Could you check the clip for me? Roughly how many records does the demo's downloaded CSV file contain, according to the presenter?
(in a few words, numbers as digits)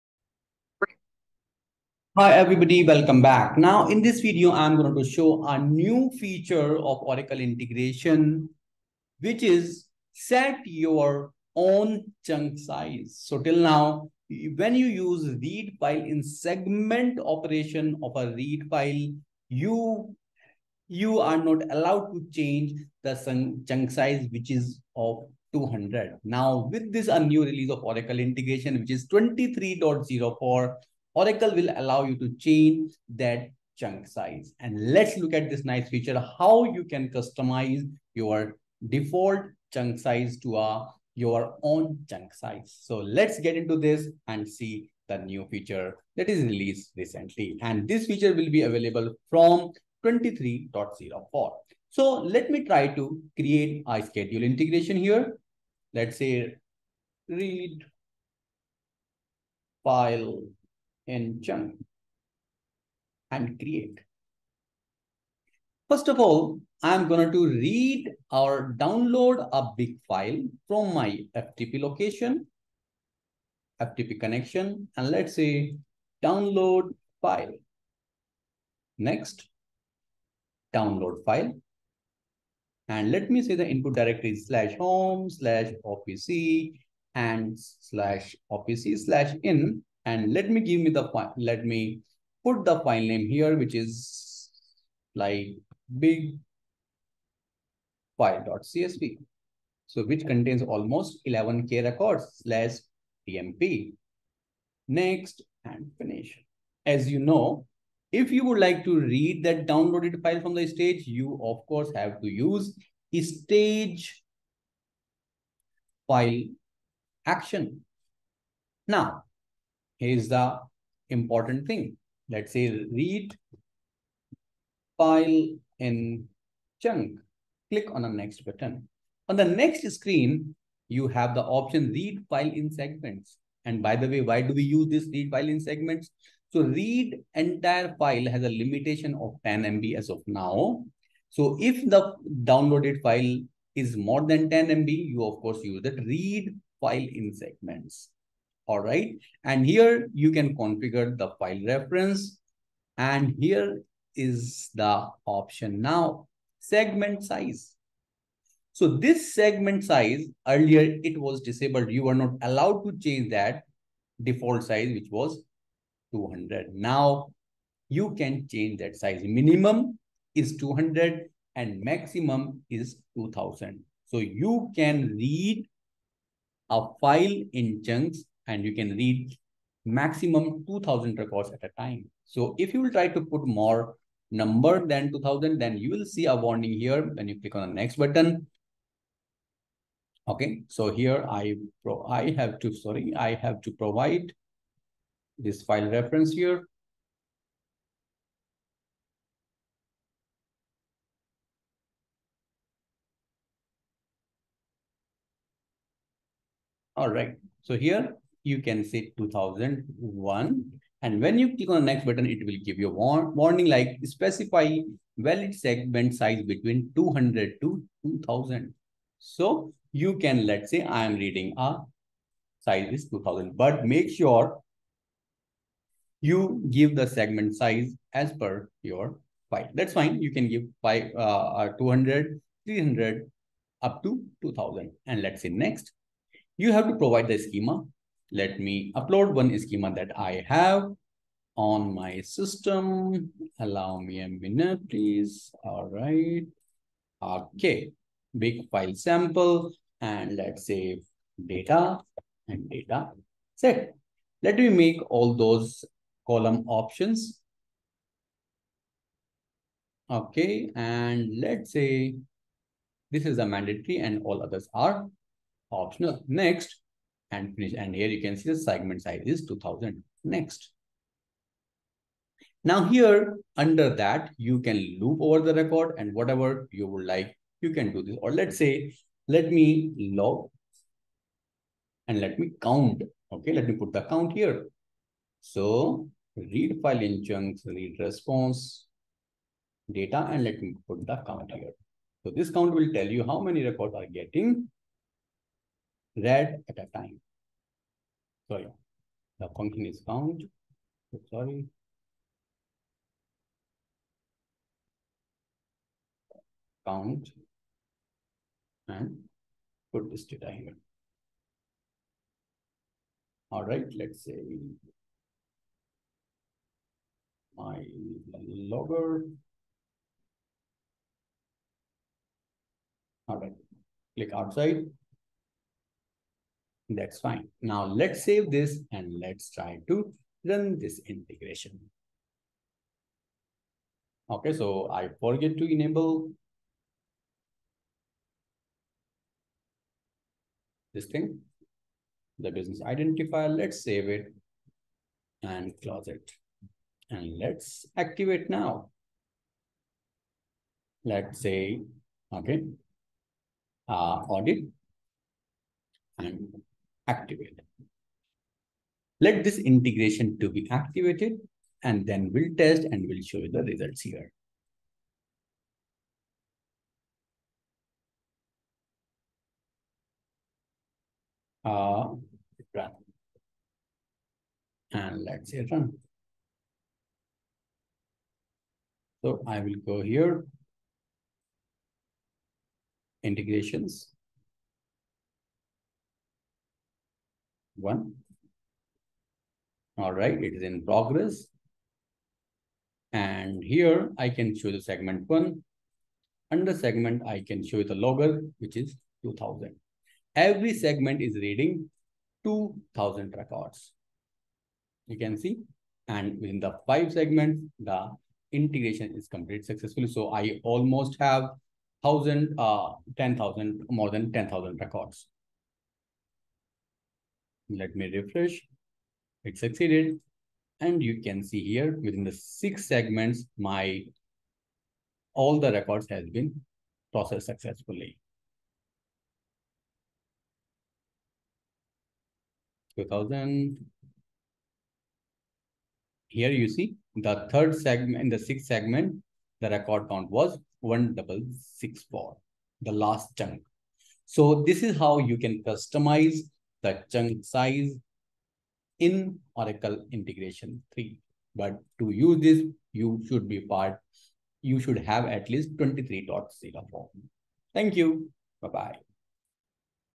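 11k.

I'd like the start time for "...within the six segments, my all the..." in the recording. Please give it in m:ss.
7:02.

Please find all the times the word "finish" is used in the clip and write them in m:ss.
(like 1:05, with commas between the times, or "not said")
1:45, 4:27.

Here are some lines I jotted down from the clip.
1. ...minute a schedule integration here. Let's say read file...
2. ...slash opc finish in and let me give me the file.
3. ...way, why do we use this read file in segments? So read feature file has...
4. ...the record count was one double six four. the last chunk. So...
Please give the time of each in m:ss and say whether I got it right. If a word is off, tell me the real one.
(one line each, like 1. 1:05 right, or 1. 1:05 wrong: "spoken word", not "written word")
1. 0:53 wrong: "create", not "minute"
2. 1:27 wrong: "slash", not "finish"
3. 2:14 wrong: "entire", not "feature"
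4. 7:19 right.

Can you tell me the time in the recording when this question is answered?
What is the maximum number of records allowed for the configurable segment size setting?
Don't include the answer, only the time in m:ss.
2:51.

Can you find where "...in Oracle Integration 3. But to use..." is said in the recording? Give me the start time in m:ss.
7:28.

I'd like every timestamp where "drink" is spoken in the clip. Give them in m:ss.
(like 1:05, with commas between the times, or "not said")
not said.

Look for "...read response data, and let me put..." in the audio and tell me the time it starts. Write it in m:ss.
4:47.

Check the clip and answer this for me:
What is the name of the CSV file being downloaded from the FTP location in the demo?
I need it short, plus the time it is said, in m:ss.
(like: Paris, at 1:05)
big file.csv, at 1:35.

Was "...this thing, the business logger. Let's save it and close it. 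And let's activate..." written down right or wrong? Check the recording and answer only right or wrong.
wrong.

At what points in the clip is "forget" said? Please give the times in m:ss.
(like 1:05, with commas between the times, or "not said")
5:35.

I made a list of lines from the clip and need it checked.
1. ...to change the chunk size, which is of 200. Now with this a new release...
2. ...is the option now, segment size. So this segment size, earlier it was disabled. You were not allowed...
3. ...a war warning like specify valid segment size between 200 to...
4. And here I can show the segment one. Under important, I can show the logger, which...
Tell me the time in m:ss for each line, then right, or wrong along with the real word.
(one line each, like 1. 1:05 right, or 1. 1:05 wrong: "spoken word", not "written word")
1. 0:22 right
2. 2:34 right
3. 3:32 right
4. 6:33 wrong: "segment", not "important".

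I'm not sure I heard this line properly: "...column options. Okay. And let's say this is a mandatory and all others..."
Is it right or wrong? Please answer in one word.
right.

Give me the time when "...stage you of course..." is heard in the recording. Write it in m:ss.
1:50.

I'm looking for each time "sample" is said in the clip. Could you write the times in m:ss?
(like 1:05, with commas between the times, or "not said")
4:08.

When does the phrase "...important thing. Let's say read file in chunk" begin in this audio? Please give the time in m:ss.
2:01.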